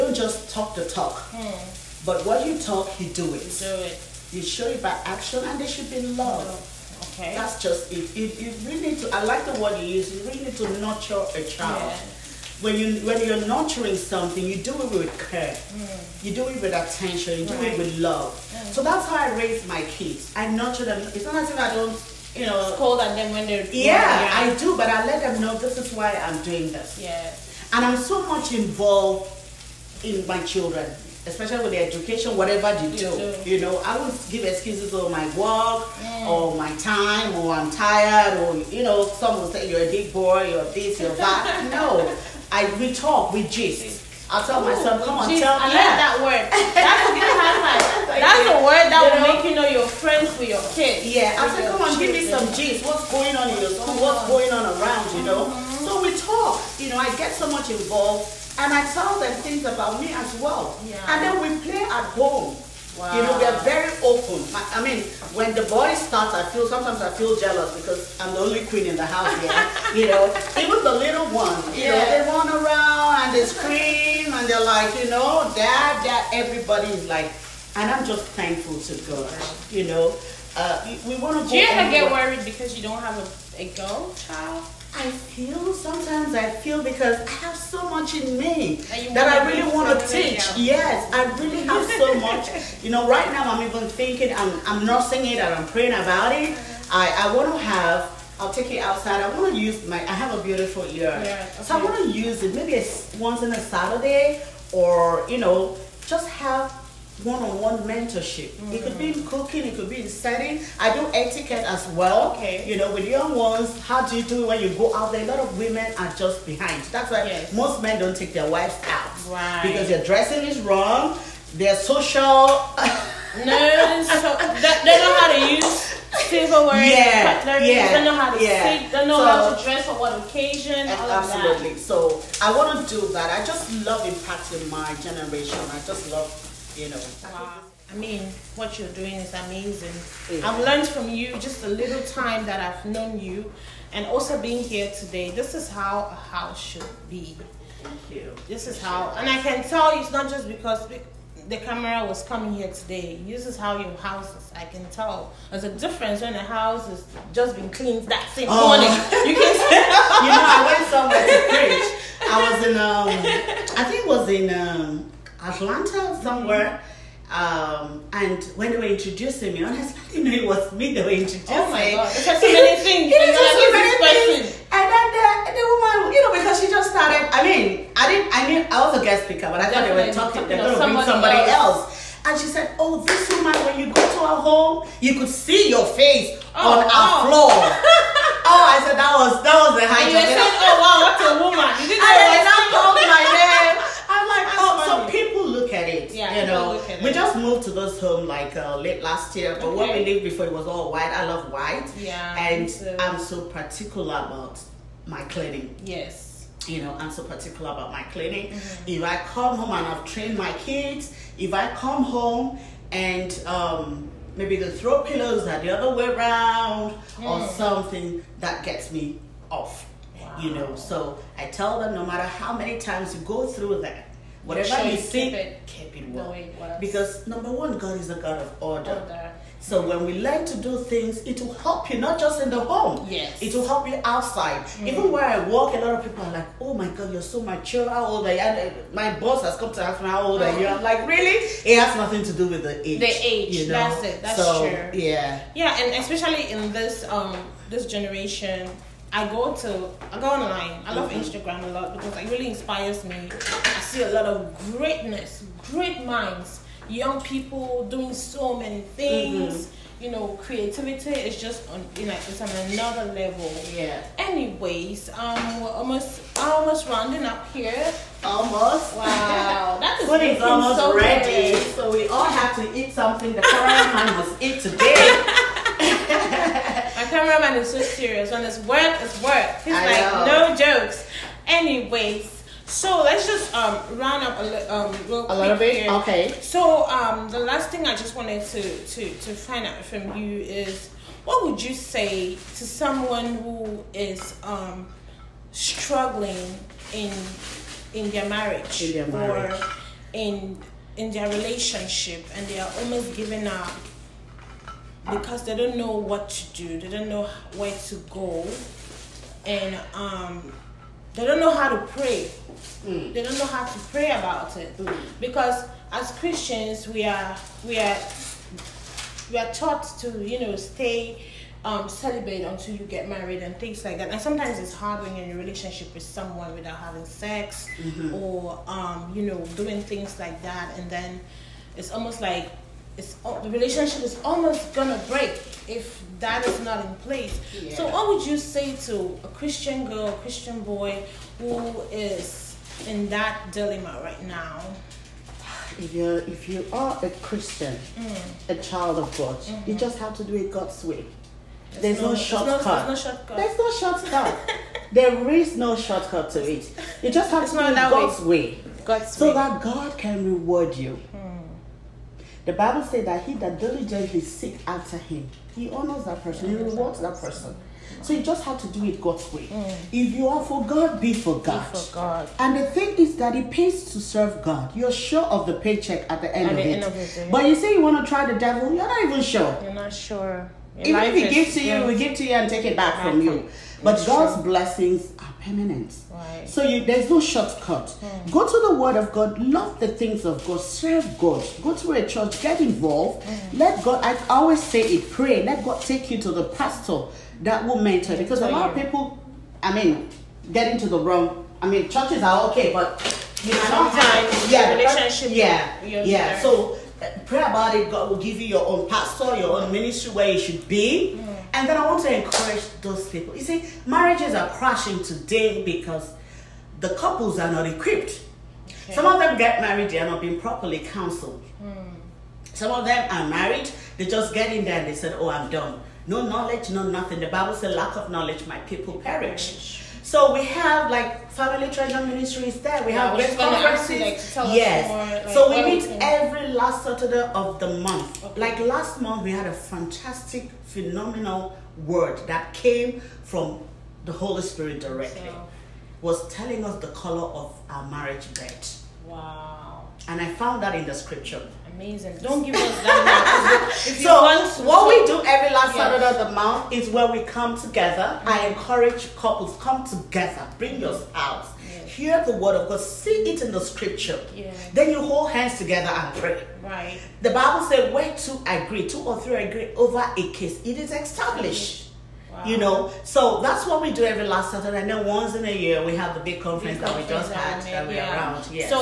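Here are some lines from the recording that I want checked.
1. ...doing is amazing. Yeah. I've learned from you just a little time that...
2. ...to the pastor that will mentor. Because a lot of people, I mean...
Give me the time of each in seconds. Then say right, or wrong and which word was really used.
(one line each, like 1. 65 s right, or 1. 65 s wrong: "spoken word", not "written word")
1. 138 s right
2. 396 s right.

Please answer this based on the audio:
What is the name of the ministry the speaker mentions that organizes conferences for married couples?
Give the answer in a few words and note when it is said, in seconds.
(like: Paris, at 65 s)
Family Treasure Ministries, at 431 s.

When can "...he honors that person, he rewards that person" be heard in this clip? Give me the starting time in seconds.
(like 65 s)
365 s.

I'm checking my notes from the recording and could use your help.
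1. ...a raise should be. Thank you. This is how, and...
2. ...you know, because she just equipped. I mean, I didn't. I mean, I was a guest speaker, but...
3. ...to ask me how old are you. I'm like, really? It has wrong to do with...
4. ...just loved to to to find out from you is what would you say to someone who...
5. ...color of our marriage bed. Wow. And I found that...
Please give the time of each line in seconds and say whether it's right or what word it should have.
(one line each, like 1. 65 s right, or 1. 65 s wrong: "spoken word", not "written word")
1. 146 s wrong: "house", not "raise"
2. 176 s wrong: "started", not "equipped"
3. 239 s wrong: "nothing", not "wrong"
4. 287 s wrong: "wanted", not "loved"
5. 446 s right.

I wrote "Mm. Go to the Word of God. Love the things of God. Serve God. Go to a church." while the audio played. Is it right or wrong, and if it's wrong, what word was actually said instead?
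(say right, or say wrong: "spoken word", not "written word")
right.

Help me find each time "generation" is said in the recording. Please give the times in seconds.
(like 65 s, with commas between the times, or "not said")
135 s, 247 s.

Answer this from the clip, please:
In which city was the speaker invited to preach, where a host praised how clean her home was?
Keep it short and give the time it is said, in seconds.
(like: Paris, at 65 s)
Atlanta, at 165 s.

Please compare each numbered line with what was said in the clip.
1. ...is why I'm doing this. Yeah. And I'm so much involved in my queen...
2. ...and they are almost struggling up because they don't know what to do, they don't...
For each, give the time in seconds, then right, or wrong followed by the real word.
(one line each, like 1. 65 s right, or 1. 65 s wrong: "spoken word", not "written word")
1. 25 s wrong: "children", not "queen"
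2. 302 s wrong: "giving", not "struggling".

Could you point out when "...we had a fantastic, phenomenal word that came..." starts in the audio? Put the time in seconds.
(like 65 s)
439 s.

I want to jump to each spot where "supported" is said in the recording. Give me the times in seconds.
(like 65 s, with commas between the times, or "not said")
not said.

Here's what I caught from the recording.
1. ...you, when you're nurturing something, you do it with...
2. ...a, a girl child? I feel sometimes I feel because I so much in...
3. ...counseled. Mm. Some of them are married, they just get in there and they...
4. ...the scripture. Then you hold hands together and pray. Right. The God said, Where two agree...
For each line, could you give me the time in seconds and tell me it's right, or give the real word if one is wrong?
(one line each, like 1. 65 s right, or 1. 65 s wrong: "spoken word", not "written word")
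1. 12 s right
2. 83 s right
3. 420 s right
4. 463 s wrong: "Bible", not "God".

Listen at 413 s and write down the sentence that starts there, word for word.
You see, marriages are crashing today because the couples are not equipped.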